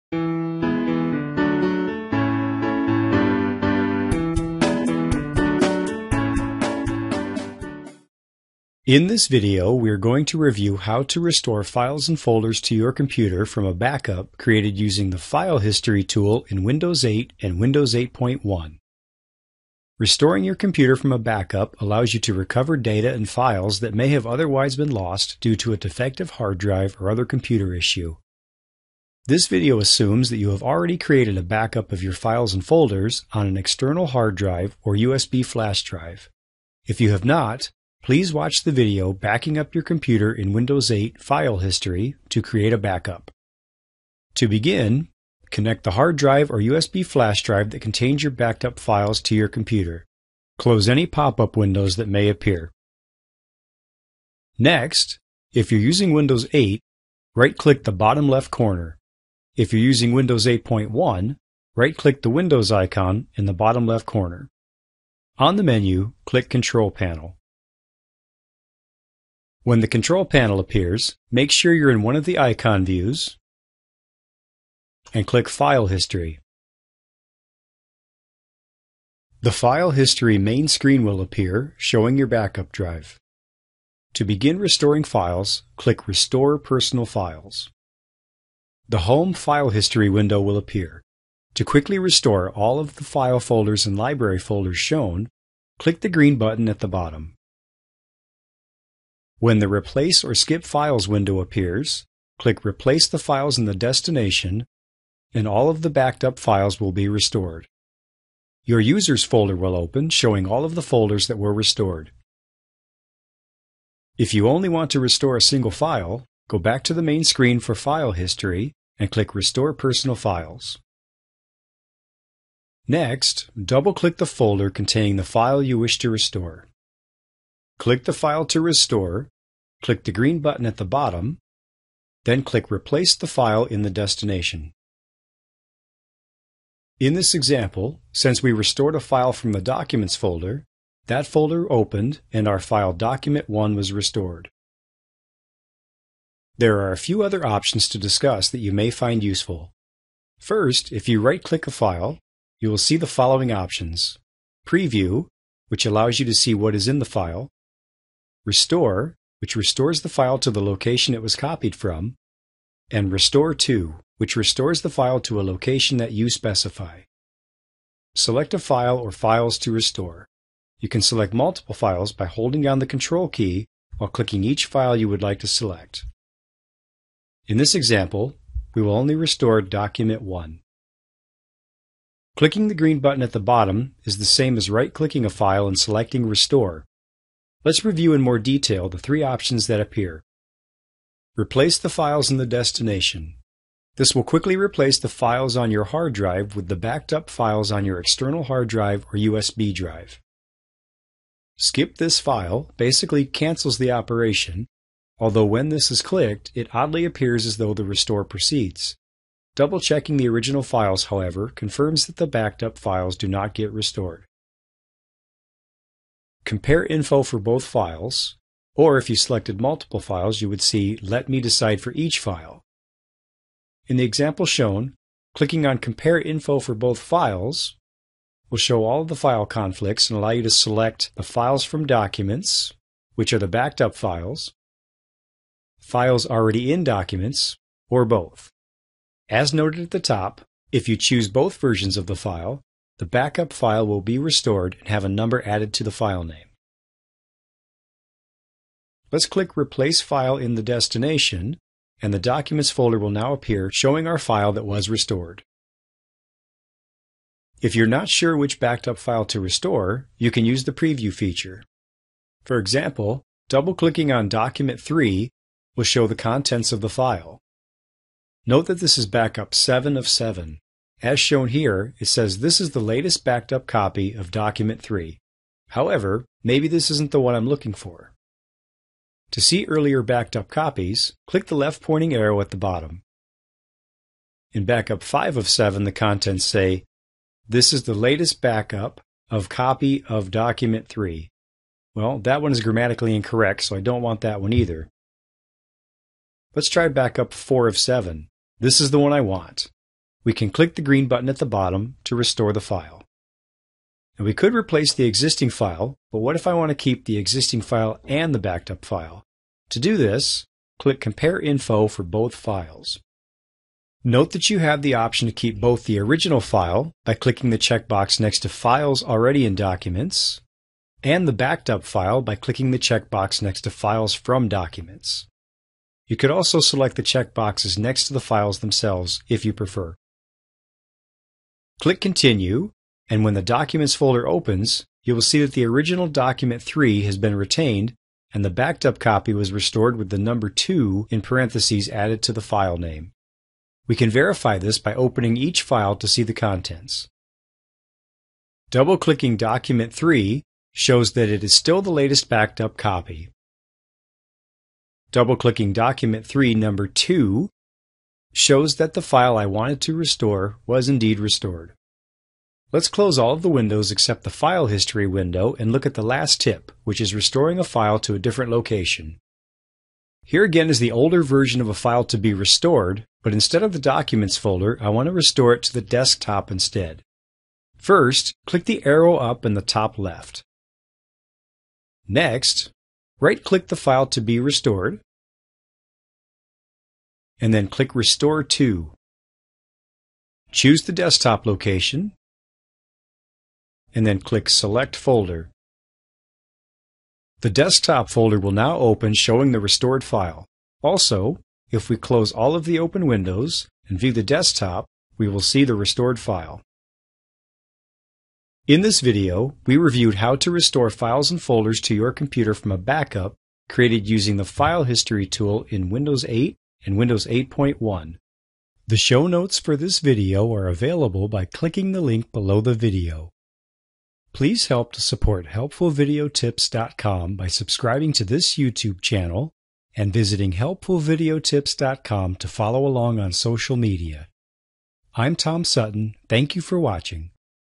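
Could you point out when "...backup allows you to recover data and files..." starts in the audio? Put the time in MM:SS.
00:21.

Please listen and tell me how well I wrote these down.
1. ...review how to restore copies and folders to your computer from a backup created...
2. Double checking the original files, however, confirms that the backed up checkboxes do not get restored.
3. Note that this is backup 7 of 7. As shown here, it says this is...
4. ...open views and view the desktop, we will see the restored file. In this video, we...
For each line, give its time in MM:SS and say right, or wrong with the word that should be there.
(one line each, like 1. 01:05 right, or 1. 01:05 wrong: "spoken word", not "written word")
1. 00:10 wrong: "files", not "copies"
2. 03:29 wrong: "files", not "checkboxes"
3. 04:28 right
4. 06:42 wrong: "windows", not "views".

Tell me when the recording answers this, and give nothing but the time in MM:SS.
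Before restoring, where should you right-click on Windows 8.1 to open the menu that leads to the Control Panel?
01:02.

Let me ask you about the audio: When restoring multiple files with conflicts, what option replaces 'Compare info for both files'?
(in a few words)
Let me decide for each file.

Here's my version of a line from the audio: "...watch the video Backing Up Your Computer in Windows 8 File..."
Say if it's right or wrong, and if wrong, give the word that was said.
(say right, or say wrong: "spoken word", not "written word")
right.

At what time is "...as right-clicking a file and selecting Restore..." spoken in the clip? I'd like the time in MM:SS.
03:04.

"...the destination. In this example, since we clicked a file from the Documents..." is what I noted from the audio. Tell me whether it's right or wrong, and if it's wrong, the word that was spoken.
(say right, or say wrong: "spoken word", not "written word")
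wrong: "restored", not "clicked".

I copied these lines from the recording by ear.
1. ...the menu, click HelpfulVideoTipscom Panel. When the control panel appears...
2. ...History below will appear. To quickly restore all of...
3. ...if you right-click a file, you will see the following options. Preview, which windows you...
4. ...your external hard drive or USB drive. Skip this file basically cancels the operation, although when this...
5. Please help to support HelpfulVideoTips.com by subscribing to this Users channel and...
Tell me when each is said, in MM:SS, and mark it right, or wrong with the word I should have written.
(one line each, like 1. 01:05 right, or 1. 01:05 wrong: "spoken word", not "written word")
1. 01:05 wrong: "Control", not "HelpfulVideoTipscom"
2. 01:29 wrong: "window", not "below"
3. 02:30 wrong: "allows", not "windows"
4. 03:17 right
5. 07:04 wrong: "YouTube", not "Users".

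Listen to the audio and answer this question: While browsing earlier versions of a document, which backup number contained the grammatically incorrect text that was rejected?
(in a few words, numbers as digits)
5 of 7.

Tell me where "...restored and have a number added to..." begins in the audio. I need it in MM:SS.
04:04.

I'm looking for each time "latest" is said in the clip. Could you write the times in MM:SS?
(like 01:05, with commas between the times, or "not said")
04:32, 04:47, 05:51.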